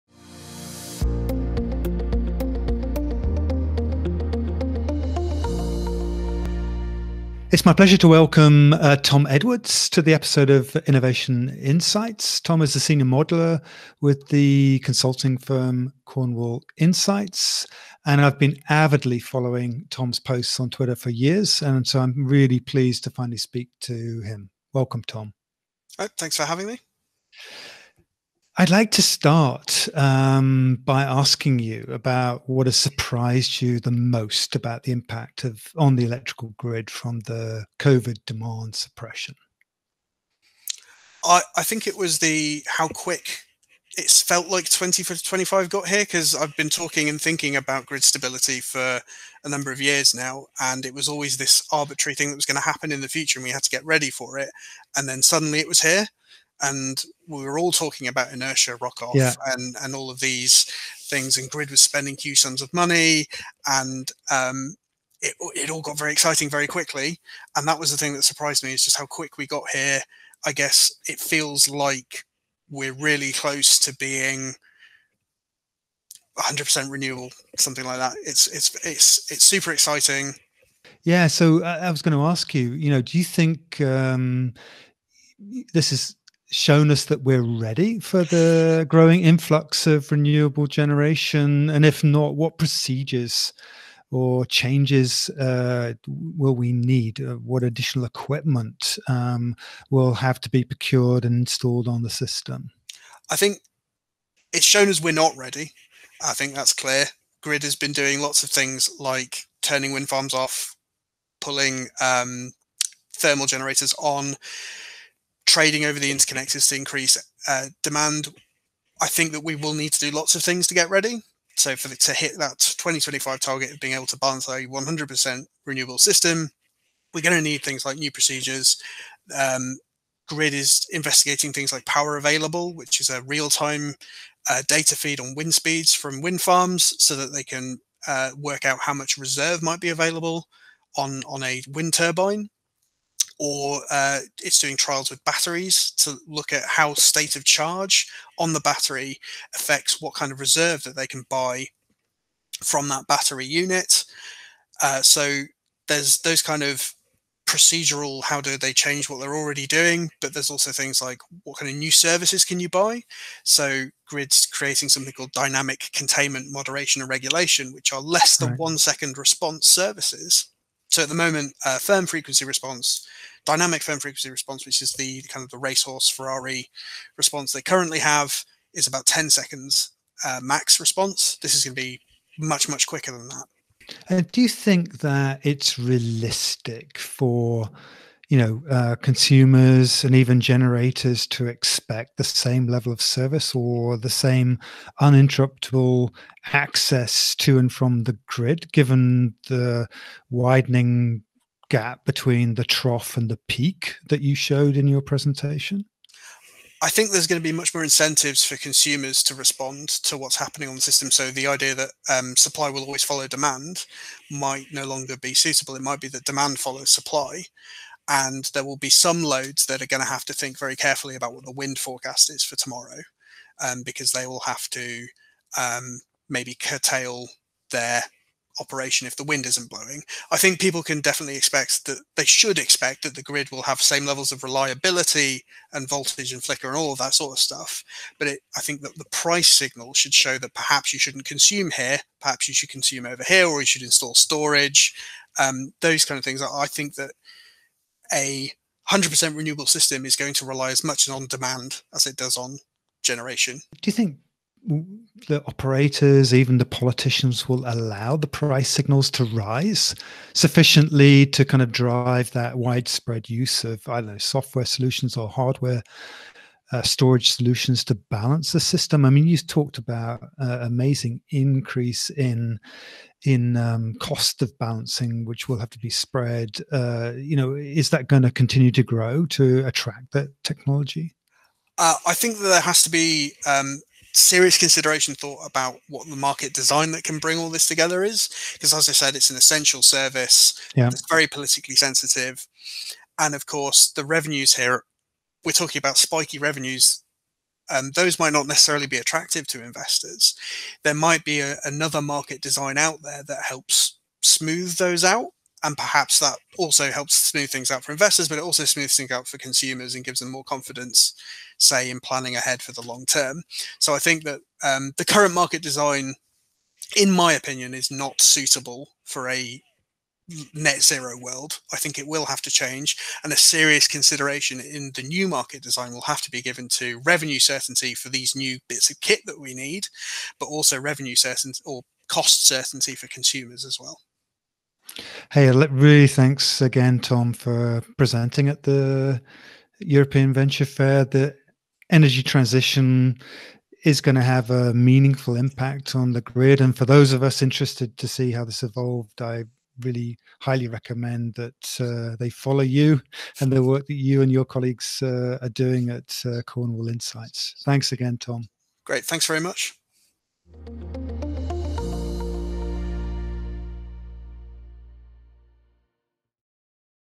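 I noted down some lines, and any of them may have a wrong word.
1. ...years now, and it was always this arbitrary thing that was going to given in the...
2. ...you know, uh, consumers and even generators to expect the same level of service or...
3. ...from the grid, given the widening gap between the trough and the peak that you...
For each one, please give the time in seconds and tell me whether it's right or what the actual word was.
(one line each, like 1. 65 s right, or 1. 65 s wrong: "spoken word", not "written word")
1. 49 s wrong: "happen", not "given"
2. 188 s right
3. 197 s right.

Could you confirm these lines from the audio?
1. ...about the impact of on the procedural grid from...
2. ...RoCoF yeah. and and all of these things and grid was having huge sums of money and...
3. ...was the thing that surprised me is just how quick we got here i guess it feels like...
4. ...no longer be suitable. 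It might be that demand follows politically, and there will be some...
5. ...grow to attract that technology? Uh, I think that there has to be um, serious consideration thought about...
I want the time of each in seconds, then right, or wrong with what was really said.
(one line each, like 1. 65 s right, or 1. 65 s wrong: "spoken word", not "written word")
1. 34 s wrong: "electrical", not "procedural"
2. 58 s wrong: "spending", not "having"
3. 67 s right
4. 214 s wrong: "supply", not "politically"
5. 278 s right.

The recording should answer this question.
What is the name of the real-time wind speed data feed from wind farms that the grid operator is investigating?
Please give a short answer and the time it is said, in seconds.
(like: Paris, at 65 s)
power available, at 131 s.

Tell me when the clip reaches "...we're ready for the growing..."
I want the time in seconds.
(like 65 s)
87 s.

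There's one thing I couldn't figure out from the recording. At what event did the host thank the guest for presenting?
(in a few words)
European Venture Fair.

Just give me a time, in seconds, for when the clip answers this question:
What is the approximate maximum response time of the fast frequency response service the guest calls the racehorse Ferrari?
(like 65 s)
179 s.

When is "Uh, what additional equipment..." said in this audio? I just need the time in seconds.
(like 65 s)
97 s.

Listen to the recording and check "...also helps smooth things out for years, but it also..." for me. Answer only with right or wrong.
wrong.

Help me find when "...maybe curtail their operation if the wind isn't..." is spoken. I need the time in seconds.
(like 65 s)
226 s.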